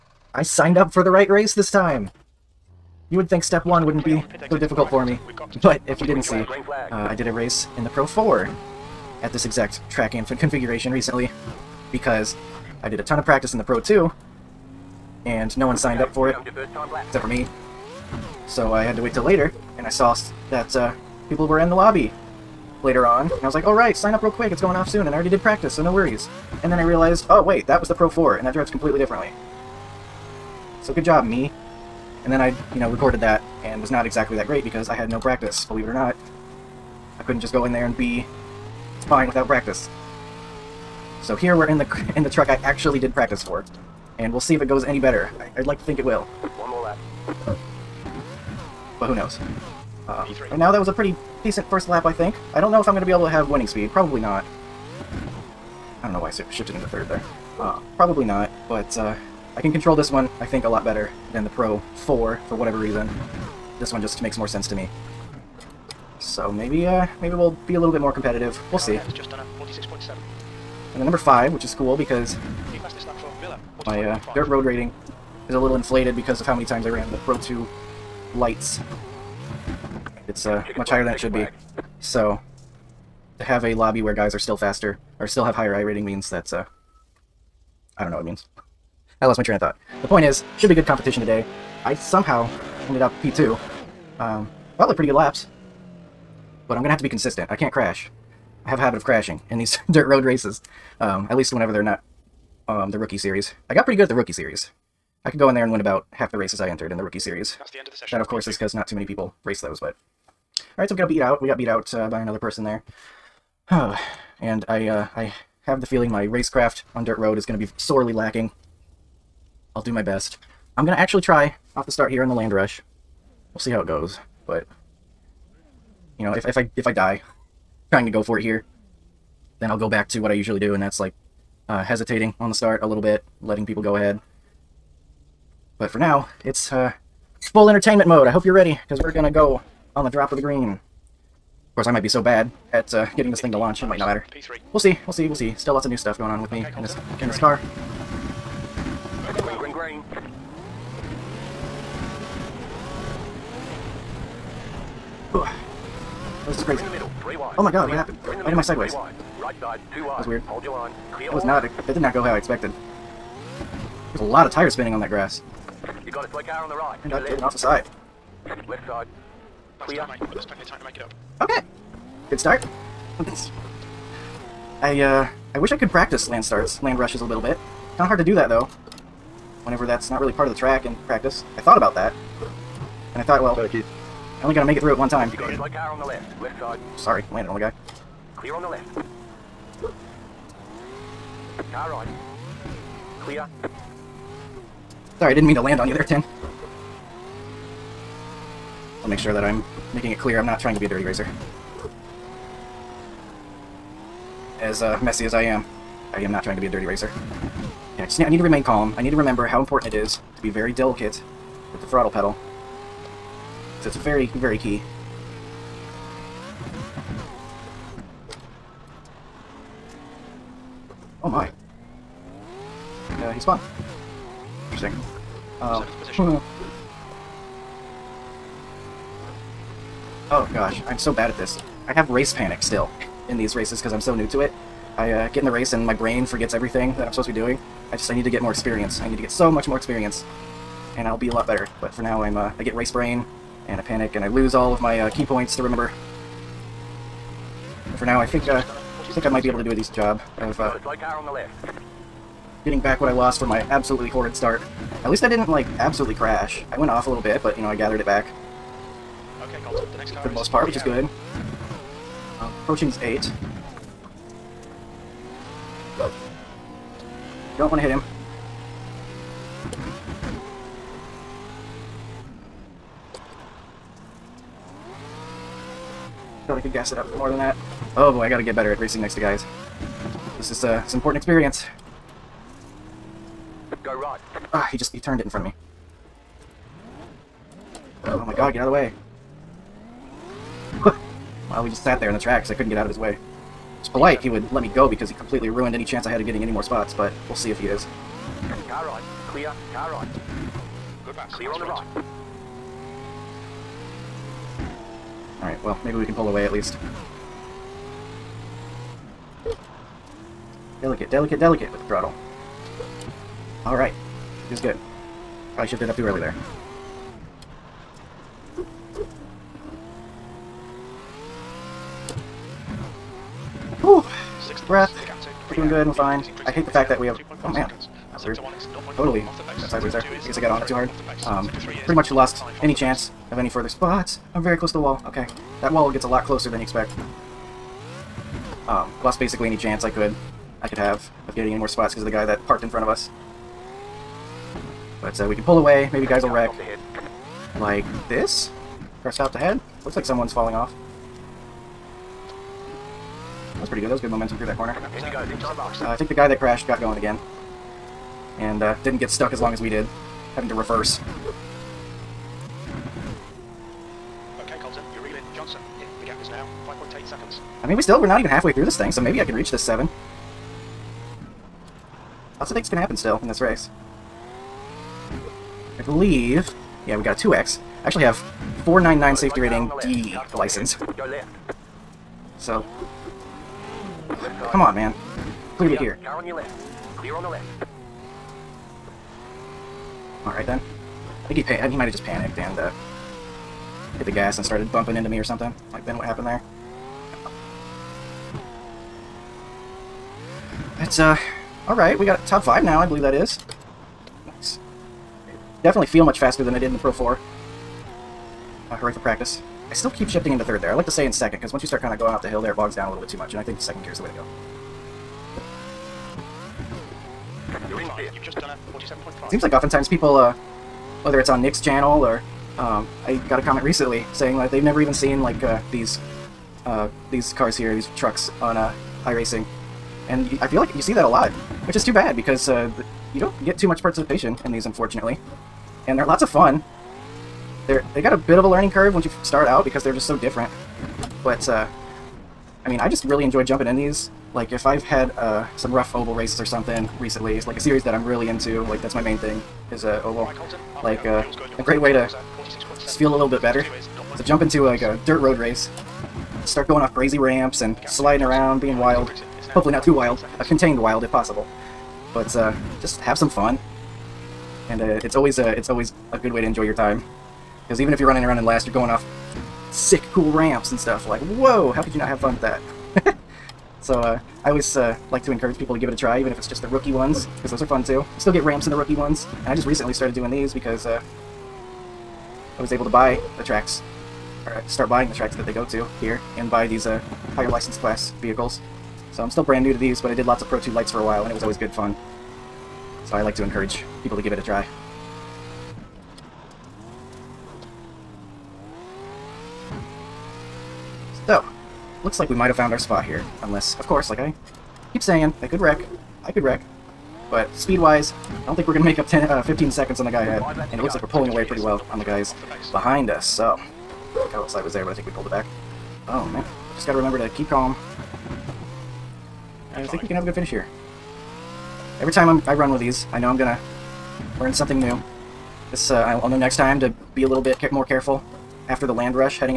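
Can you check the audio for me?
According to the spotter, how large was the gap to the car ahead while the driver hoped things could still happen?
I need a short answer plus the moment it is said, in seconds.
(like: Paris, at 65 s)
5.8 seconds, at 366 s.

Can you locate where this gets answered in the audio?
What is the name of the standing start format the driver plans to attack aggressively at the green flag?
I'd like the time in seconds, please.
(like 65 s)
122 s.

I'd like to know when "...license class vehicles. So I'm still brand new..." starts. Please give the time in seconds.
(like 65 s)
487 s.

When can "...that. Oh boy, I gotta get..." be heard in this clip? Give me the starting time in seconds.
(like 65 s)
277 s.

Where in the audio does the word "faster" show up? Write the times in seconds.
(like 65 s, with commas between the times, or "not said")
84 s, 406 s.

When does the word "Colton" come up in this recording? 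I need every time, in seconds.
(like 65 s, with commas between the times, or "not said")
259 s, 364 s.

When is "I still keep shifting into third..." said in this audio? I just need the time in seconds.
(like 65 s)
409 s.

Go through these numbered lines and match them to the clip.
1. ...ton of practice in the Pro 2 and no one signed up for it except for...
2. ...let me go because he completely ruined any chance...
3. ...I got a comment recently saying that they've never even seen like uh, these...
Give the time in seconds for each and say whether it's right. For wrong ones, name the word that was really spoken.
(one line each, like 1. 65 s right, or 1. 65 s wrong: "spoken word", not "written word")
1. 13 s right
2. 294 s right
3. 423 s right.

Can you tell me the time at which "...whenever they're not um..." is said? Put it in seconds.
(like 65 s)
101 s.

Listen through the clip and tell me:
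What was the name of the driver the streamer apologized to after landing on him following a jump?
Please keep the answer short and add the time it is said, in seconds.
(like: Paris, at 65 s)
Tim, at 196 s.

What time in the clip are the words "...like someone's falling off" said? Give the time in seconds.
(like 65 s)
349 s.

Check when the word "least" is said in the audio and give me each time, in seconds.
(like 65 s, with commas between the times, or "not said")
101 s, 255 s, 306 s.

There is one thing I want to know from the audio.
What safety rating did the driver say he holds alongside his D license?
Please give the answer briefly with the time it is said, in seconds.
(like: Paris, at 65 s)
499, at 378 s.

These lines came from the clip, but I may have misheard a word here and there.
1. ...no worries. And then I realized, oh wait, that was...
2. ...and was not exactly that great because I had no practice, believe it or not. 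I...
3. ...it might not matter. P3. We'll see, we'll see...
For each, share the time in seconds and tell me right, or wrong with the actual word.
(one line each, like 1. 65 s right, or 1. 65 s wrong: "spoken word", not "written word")
1. 25 s right
2. 33 s right
3. 143 s right.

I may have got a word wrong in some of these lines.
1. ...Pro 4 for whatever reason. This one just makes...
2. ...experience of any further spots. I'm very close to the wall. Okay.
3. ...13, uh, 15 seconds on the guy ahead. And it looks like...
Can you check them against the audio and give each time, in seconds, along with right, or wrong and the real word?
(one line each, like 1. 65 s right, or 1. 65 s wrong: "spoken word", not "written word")
1. 61 s right
2. 332 s wrong: "chance", not "experience"
3. 509 s wrong: "10", not "13".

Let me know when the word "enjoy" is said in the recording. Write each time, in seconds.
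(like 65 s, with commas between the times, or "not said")
443 s, 466 s.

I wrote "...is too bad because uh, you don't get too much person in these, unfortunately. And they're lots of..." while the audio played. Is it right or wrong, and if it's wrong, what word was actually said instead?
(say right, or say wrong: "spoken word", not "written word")
wrong: "participation", not "person".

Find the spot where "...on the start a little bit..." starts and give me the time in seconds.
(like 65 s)
132 s.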